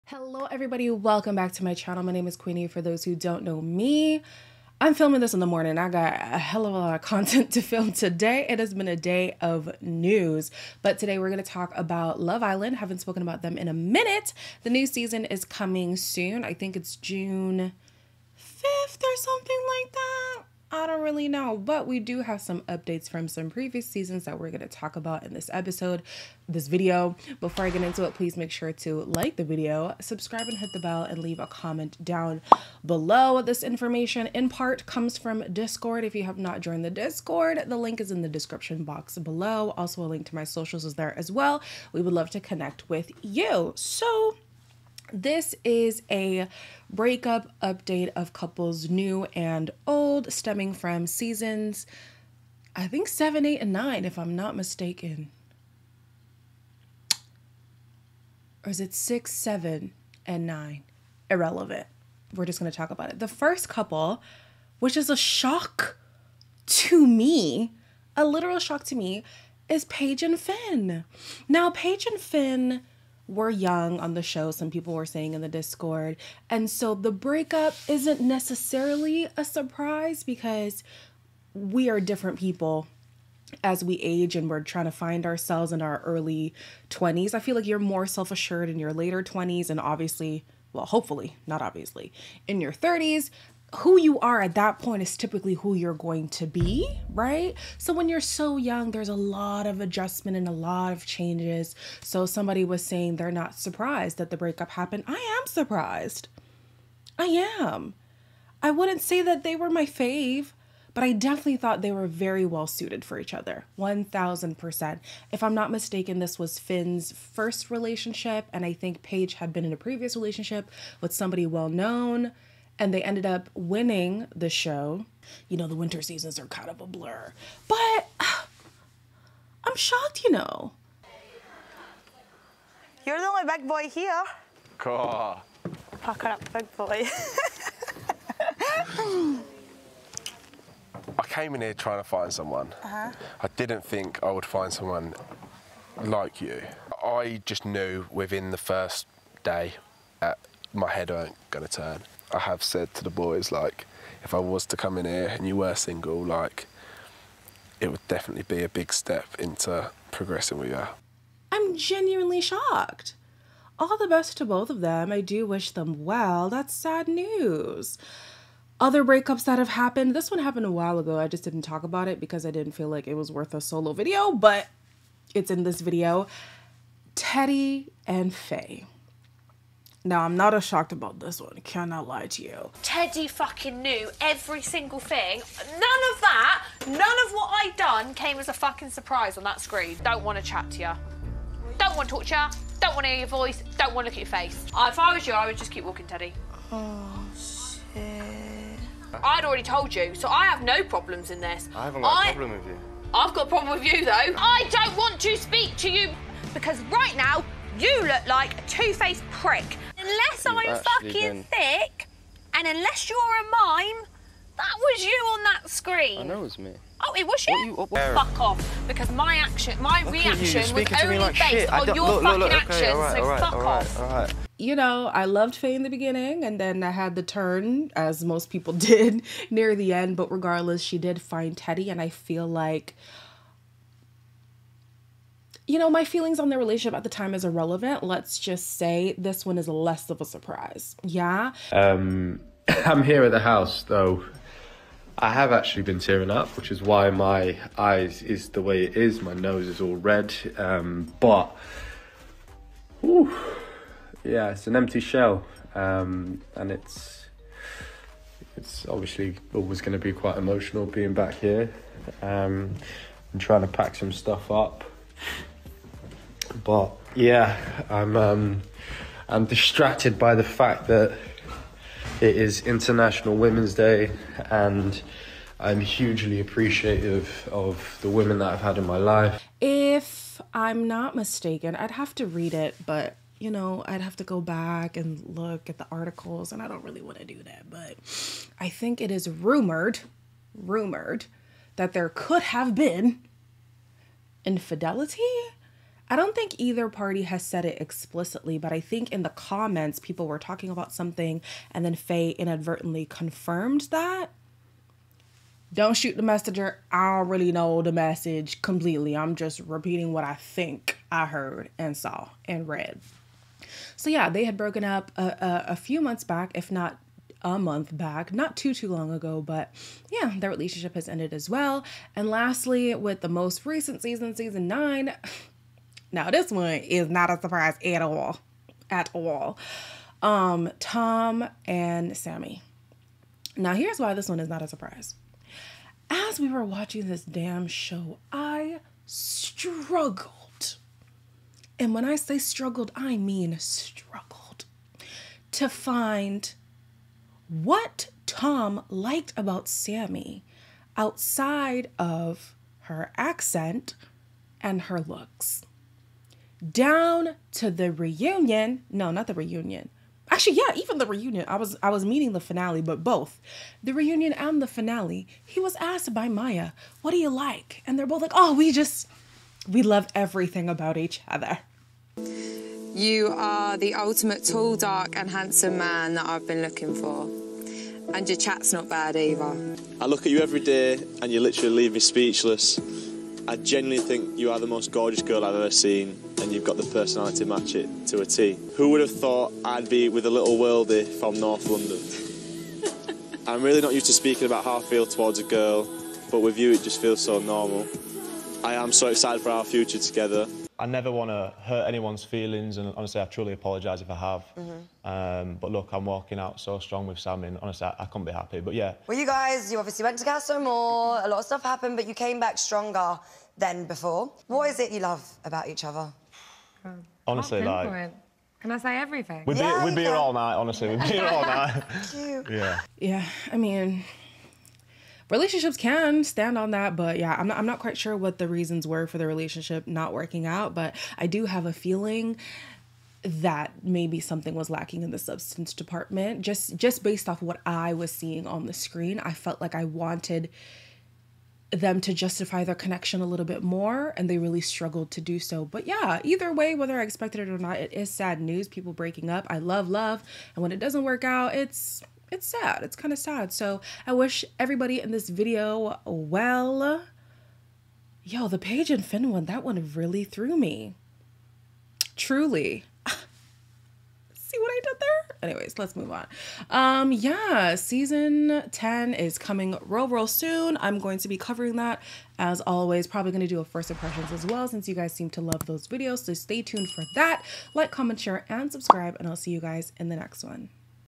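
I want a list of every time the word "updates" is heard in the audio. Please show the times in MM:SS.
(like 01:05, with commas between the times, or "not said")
00:22, 00:47.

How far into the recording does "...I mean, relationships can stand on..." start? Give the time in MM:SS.
07:03.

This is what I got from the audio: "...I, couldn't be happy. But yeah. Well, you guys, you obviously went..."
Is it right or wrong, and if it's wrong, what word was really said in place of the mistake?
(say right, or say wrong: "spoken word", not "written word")
right.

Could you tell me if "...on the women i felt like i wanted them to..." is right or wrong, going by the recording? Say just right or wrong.
wrong.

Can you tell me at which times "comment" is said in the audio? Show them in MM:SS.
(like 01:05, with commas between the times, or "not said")
00:31, 04:59, 07:57.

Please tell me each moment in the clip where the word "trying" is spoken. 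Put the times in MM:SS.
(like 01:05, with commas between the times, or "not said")
01:24, 02:21, 04:23.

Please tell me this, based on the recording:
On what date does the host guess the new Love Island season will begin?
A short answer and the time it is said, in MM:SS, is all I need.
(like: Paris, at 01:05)
June 5th, at 00:16.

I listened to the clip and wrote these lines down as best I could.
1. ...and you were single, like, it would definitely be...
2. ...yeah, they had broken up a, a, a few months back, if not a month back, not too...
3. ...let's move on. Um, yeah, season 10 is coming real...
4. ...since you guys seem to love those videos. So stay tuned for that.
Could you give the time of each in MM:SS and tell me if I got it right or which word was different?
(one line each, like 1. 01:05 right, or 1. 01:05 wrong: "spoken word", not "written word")
1. 02:35 right
2. 05:14 right
3. 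07:45 right
4. 07:54 right.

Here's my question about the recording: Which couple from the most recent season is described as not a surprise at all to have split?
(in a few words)
Tom and Samie.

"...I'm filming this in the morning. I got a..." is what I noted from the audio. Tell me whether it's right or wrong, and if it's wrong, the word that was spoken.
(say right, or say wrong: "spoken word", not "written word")
right.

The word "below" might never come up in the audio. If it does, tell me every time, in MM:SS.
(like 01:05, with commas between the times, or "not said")
00:32, 00:39.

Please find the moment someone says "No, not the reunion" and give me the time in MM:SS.
05:58.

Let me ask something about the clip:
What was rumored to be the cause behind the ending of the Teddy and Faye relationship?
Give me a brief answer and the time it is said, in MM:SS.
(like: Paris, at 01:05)
infidelity, at 04:54.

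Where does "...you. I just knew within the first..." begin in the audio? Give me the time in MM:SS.
02:26.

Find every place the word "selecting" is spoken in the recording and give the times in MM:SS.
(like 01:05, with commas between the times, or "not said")
not said.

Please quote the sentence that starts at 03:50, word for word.
But regardless, she did find Teddy, and I feel like you know, my feelings on their relationship at the time is irrelevant.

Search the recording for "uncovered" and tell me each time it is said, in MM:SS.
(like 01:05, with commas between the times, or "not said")
not said.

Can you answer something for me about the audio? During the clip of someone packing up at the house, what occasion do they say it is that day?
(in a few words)
International Women's Day.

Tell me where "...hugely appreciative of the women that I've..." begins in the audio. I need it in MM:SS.
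04:35.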